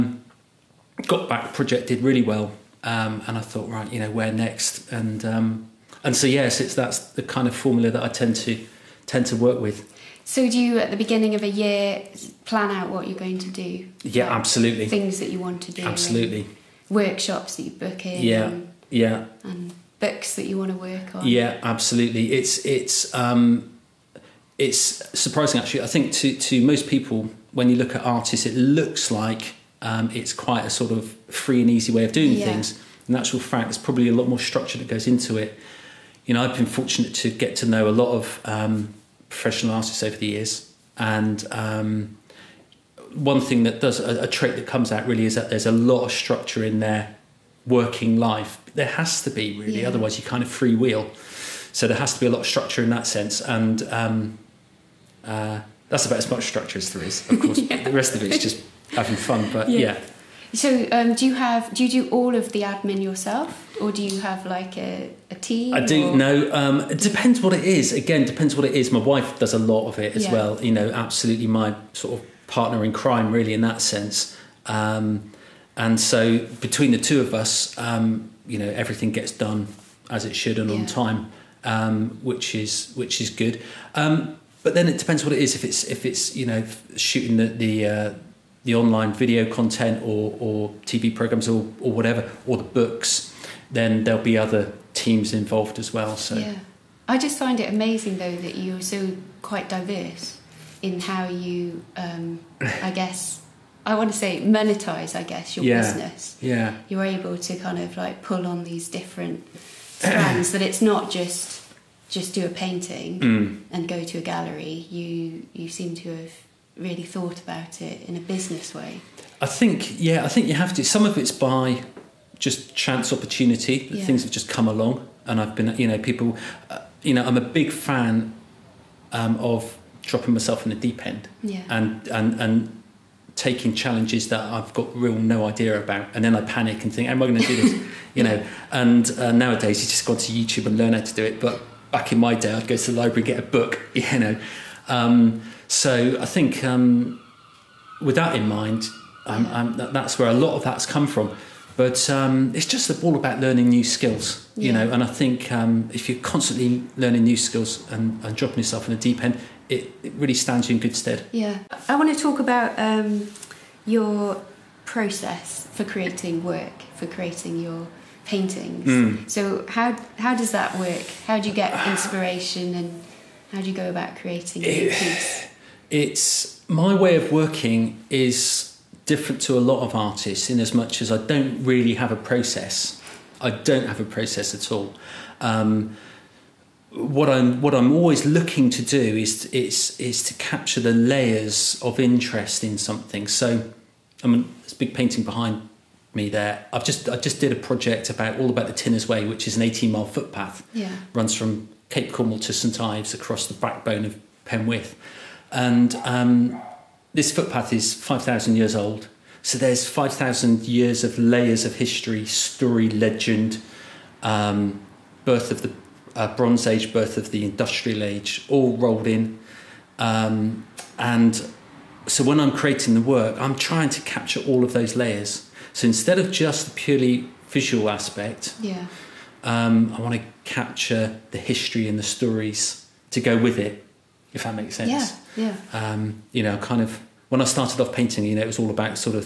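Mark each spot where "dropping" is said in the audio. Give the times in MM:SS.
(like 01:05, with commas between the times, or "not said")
02:10, 02:38.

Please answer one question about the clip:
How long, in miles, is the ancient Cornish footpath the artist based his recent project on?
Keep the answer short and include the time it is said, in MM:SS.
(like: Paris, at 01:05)
18 miles, at 03:19.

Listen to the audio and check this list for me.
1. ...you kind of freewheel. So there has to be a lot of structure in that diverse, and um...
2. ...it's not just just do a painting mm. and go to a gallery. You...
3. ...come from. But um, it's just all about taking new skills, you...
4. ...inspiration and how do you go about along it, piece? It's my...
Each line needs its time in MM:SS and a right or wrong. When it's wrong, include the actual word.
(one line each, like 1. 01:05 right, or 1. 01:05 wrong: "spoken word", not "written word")
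1. 00:50 wrong: "sense", not "diverse"
2. 01:50 right
3. 02:30 wrong: "learning", not "taking"
4. 02:51 wrong: "creating", not "along".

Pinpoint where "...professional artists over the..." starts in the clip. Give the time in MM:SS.
00:39.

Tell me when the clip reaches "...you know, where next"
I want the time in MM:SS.
00:03.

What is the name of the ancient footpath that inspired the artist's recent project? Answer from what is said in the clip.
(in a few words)
Tinner's Way.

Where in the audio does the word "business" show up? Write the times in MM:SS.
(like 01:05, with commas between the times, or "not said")
01:45, 01:58.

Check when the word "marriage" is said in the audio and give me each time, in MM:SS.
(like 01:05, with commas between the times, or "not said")
not said.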